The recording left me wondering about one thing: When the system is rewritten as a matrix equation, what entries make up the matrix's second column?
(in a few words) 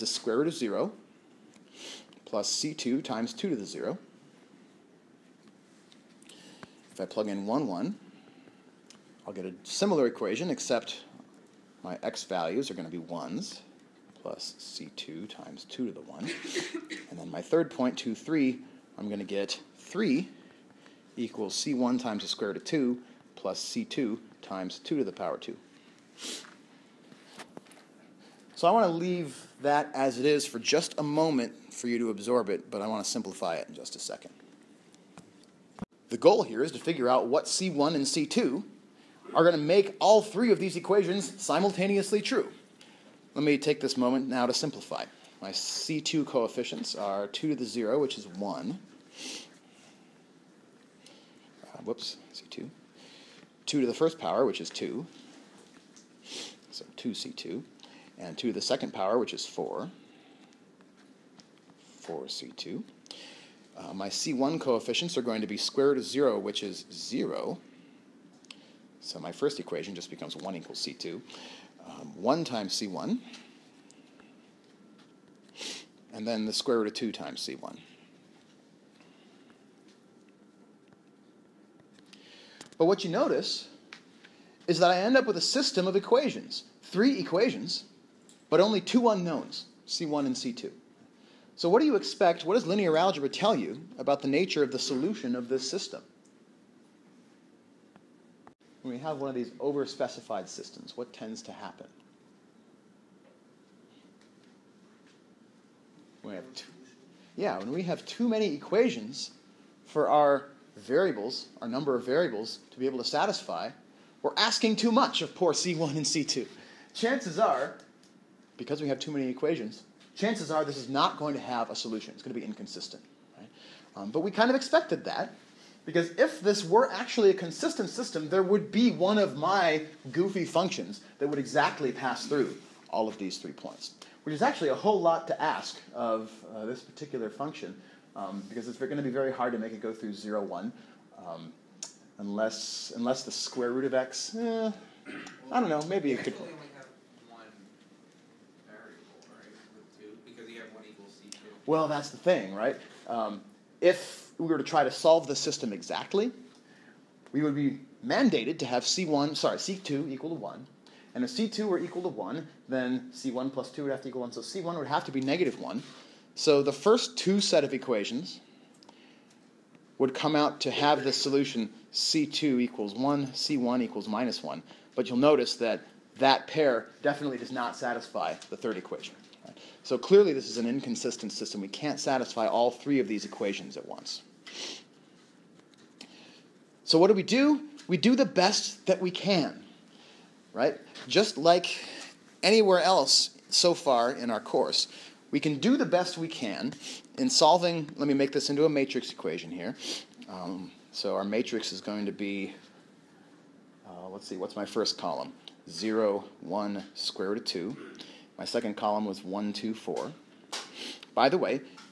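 1, 2, 4.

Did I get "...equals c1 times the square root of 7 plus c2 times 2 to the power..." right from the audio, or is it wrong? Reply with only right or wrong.
wrong.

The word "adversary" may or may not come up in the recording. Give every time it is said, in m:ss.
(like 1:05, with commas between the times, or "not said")
not said.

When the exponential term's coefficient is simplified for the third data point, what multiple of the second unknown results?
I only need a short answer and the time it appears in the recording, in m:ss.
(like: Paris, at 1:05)
4C2, at 1:02.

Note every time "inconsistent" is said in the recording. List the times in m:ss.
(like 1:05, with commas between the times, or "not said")
2:02, 3:00.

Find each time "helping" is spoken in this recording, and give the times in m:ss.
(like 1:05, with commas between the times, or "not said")
not said.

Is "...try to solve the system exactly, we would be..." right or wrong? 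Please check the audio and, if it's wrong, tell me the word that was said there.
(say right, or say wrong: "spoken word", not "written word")
right.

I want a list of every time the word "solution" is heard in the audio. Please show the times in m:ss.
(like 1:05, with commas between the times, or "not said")
1:34, 2:01, 2:51.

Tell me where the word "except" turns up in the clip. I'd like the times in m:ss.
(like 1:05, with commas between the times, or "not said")
0:10.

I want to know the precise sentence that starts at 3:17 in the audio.
Let me make this into a matrix equation here.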